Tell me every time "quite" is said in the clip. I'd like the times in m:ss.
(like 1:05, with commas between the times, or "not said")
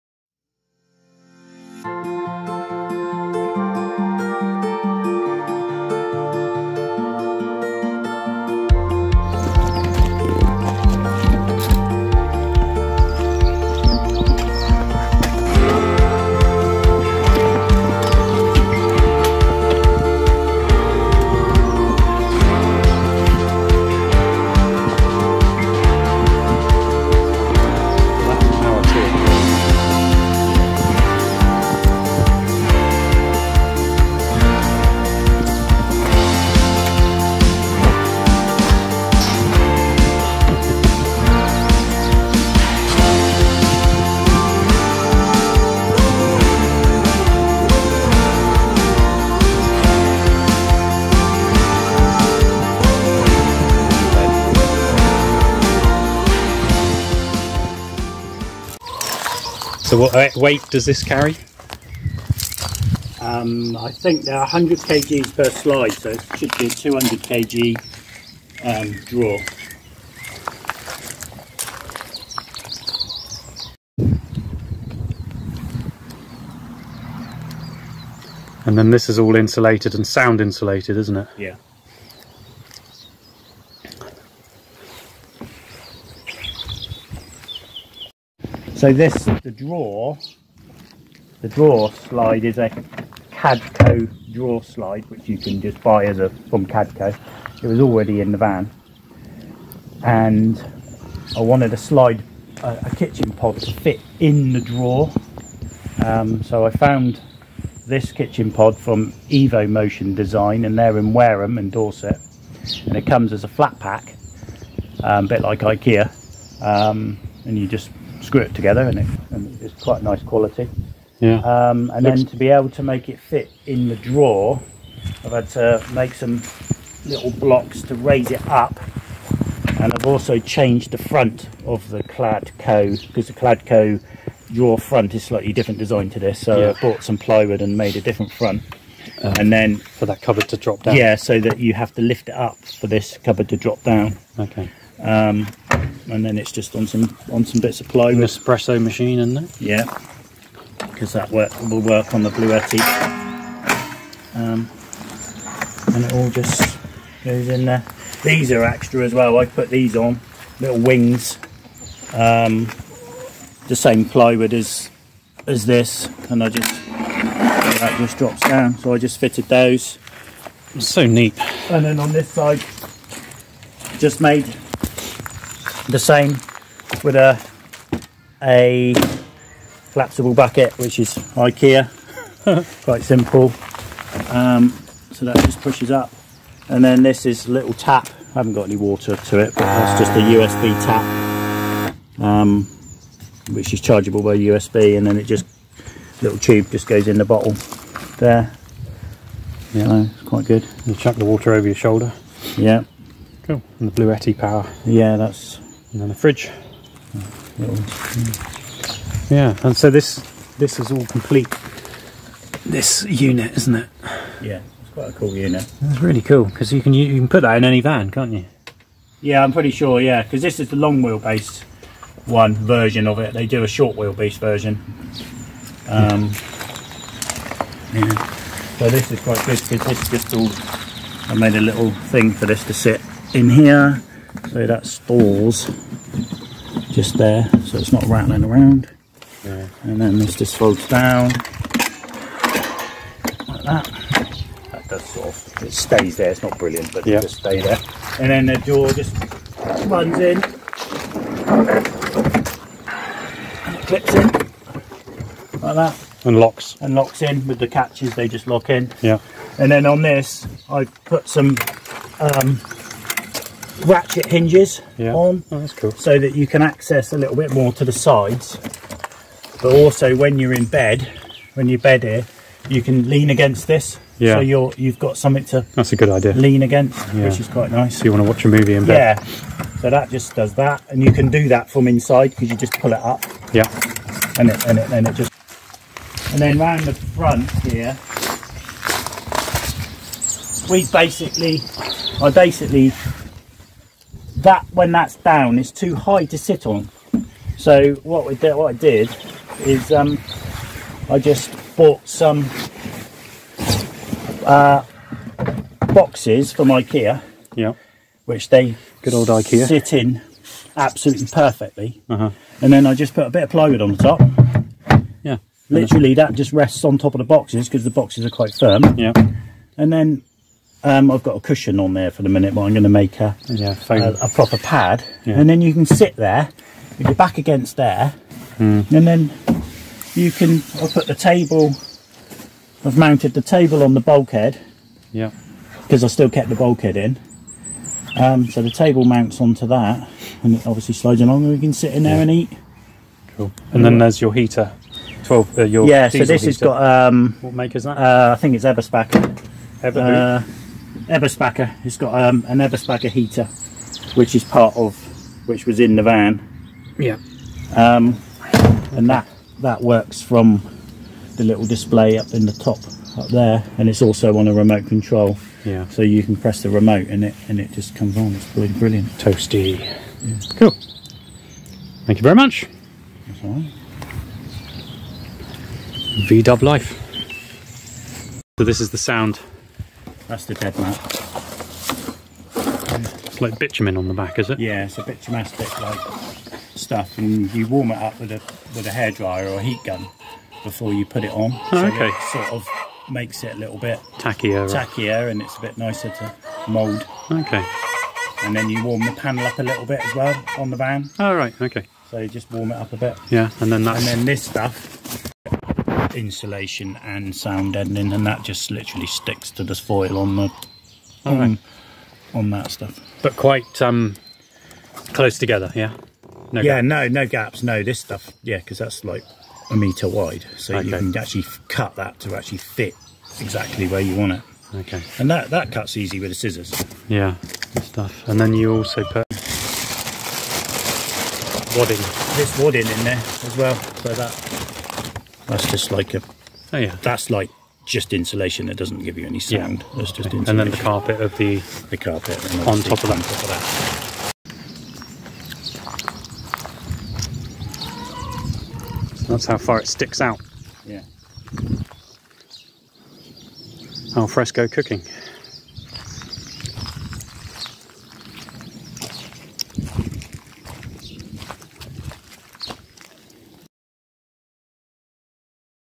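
1:59, 3:02, 3:20, 3:34, 3:49, 4:37, 5:18, 6:53.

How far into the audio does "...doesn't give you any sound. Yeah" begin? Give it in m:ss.
7:18.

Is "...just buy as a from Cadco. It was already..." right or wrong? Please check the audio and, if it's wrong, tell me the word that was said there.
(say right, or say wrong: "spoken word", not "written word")
right.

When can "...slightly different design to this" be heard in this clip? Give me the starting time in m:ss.
2:15.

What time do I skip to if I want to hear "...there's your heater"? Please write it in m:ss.
5:43.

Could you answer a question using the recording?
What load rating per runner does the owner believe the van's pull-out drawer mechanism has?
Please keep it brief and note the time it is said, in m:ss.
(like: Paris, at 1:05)
100 kg, at 1:04.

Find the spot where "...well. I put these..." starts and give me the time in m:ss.
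2:39.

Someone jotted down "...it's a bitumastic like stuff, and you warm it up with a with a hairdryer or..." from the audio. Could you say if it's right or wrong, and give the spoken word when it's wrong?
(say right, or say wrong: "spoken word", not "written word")
right.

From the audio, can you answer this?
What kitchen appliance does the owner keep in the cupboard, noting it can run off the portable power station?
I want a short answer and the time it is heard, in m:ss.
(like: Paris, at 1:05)
Espresso machine, at 2:28.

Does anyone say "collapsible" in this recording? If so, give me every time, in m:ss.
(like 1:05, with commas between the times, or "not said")
2:59.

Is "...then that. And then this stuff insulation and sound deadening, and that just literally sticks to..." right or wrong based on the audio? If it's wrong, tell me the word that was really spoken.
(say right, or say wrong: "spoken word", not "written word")
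right.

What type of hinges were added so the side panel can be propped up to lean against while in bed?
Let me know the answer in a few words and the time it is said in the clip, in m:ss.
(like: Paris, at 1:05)
Ratchet hinges, at 4:23.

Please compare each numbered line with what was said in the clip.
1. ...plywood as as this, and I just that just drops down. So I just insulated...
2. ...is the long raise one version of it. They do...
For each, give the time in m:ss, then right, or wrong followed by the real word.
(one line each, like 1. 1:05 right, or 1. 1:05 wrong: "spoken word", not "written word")
1. 2:44 wrong: "fitted", not "insulated"
2. 3:40 wrong: "wheelbase", not "raise".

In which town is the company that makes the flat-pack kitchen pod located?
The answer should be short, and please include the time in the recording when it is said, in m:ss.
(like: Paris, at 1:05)
Wareham, at 1:51.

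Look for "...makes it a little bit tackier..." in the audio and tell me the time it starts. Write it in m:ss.
6:33.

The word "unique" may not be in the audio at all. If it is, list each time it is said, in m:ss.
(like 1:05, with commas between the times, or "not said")
not said.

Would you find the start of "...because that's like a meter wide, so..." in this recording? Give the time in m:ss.
6:58.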